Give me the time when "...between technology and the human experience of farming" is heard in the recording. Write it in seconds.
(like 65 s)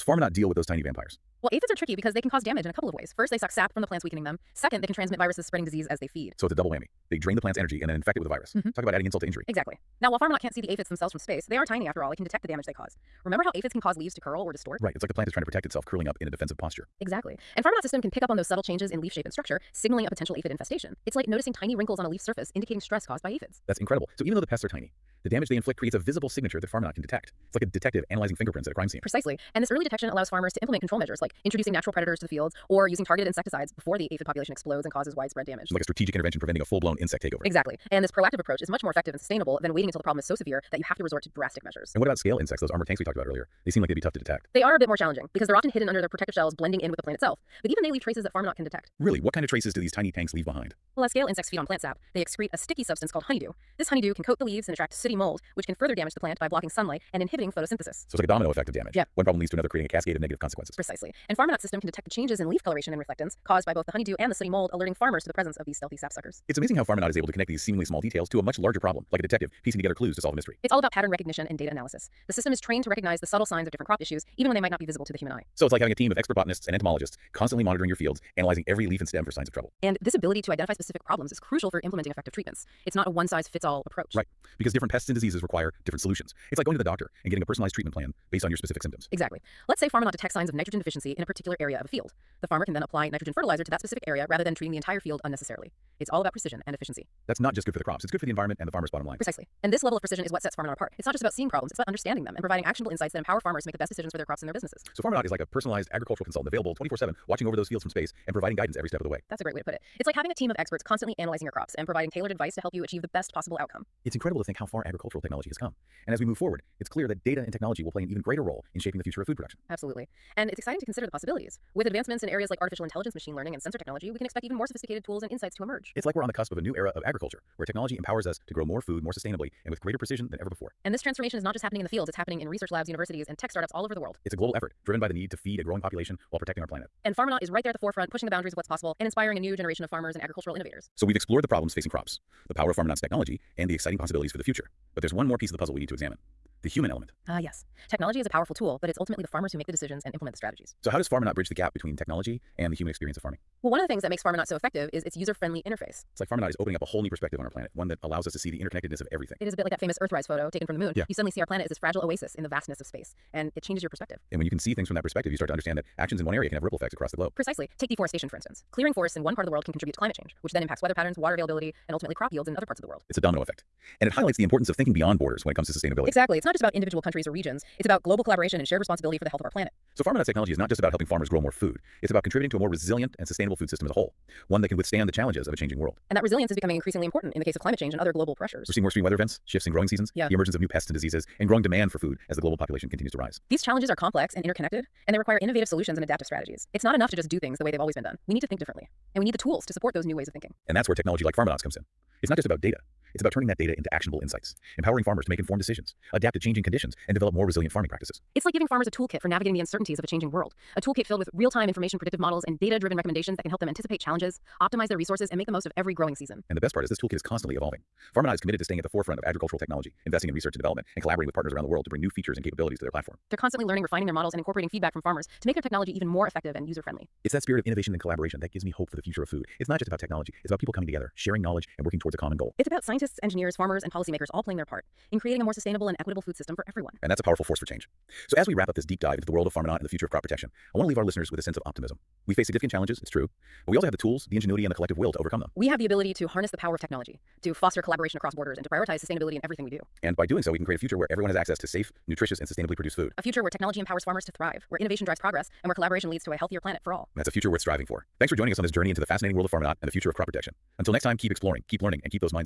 151 s.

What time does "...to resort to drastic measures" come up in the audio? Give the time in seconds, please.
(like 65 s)
40 s.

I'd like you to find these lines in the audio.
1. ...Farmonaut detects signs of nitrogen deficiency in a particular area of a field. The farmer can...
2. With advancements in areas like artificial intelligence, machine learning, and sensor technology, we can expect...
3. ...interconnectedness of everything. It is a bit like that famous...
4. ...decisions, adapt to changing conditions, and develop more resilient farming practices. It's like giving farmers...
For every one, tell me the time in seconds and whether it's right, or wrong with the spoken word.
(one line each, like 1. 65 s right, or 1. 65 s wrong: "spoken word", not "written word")
1. 89 s right
2. 121 s right
3. 158 s right
4. 205 s right.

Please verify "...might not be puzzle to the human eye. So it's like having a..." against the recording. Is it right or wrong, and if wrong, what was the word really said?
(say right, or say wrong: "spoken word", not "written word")
wrong: "visible", not "puzzle".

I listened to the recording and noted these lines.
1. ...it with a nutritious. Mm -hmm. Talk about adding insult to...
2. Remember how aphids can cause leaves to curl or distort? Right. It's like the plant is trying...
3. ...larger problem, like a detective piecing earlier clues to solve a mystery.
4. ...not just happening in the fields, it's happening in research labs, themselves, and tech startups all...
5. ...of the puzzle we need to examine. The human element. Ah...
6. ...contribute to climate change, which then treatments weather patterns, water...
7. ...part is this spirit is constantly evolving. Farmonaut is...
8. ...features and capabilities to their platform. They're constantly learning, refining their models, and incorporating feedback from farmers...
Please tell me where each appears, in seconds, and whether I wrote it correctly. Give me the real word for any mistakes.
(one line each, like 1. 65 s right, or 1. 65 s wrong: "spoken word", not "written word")
1. 8 s wrong: "virus", not "nutritious"
2. 13 s right
3. 68 s wrong: "together", not "earlier"
4. 131 s wrong: "universities", not "themselves"
5. 145 s right
6. 169 s wrong: "impacts", not "treatments"
7. 216 s wrong: "toolkit", not "spirit"
8. 222 s right.